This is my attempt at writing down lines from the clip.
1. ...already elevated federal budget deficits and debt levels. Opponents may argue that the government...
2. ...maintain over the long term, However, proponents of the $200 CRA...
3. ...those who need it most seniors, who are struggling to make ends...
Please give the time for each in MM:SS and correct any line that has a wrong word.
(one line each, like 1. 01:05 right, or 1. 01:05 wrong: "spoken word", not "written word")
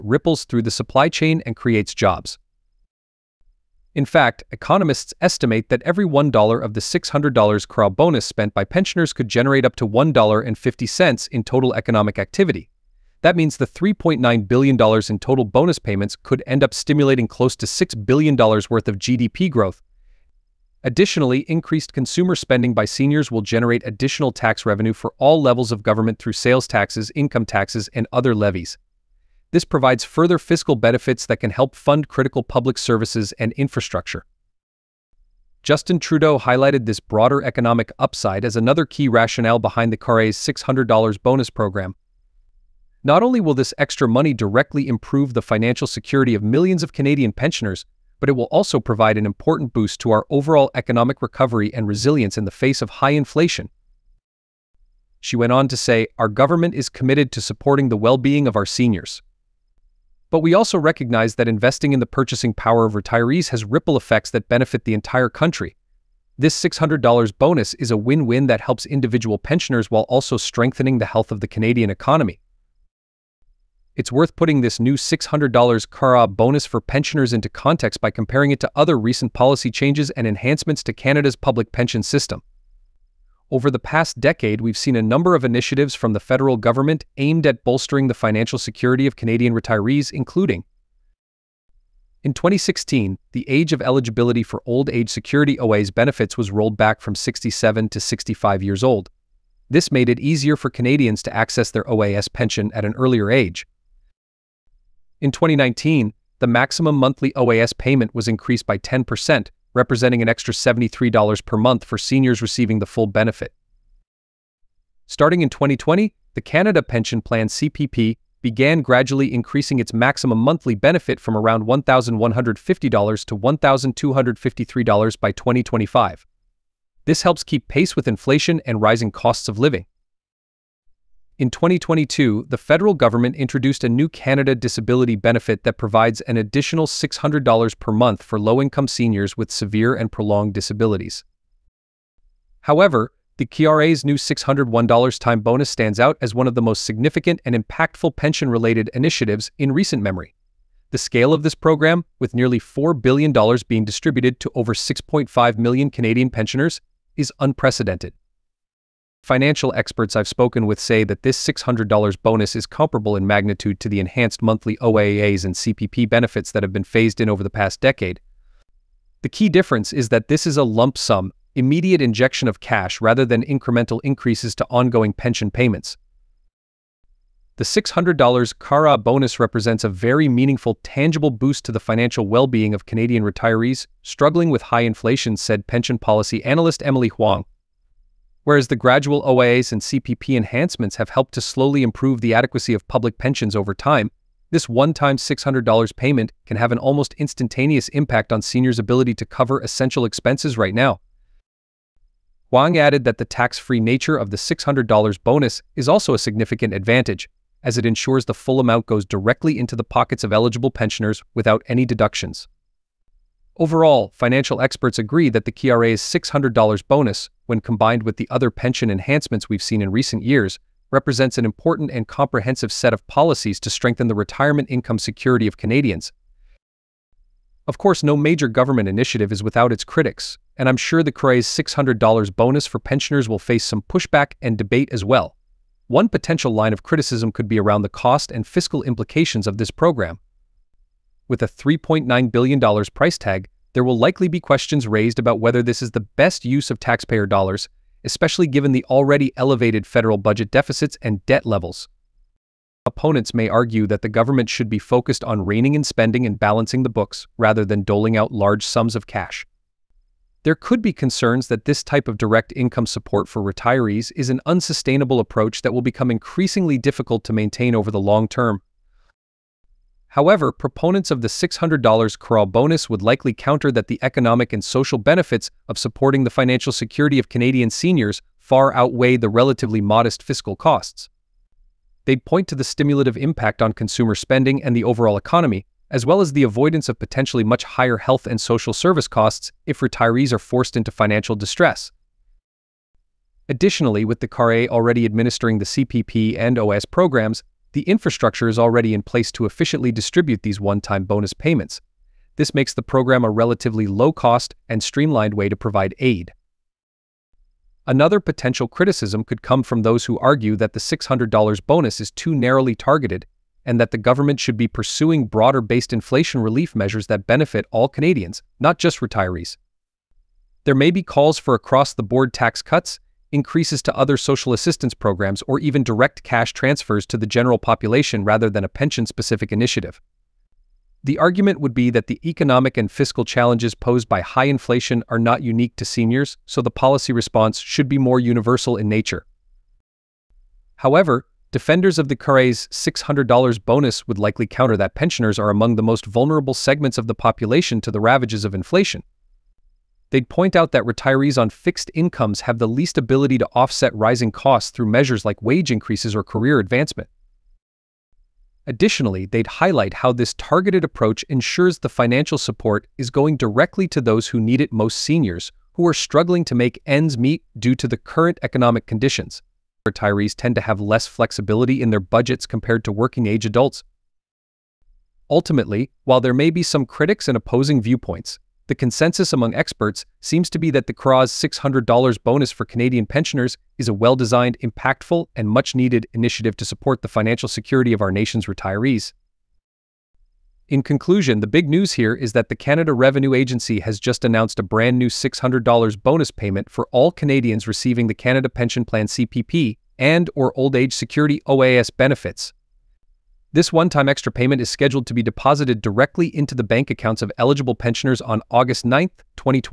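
1. 04:08 right
2. 04:27 wrong: "600", not "200"
3. 06:04 right.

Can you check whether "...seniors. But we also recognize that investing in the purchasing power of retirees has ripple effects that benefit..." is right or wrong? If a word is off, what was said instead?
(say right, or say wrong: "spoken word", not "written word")
right.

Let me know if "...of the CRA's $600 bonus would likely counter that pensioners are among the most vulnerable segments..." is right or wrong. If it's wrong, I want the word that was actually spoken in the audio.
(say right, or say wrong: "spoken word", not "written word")
right.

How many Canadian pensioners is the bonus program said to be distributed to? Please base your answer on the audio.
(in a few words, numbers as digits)
6.5 million.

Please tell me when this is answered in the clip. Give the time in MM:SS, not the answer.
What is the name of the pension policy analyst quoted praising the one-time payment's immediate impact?
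03:06.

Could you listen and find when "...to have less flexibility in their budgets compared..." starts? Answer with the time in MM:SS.
06:10.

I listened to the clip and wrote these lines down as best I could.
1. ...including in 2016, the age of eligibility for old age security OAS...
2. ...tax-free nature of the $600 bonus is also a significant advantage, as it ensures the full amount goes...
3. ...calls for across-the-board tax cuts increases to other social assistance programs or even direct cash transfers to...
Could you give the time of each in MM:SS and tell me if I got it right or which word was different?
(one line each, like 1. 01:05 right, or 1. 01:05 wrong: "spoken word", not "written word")
1. 01:30 right
2. 03:23 right
3. 05:21 right.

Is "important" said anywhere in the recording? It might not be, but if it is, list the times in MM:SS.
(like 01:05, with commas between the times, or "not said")
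00:49, 03:41.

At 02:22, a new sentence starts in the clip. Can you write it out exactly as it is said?
However, the CRA's new $601 time bonus stands out as one of the most significant and impactful pension-related initiatives in recent memory.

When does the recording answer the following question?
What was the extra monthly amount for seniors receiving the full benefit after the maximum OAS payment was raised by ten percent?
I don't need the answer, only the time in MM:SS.
01:50.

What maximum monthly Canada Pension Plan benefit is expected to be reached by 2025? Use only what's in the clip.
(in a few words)
$1,253.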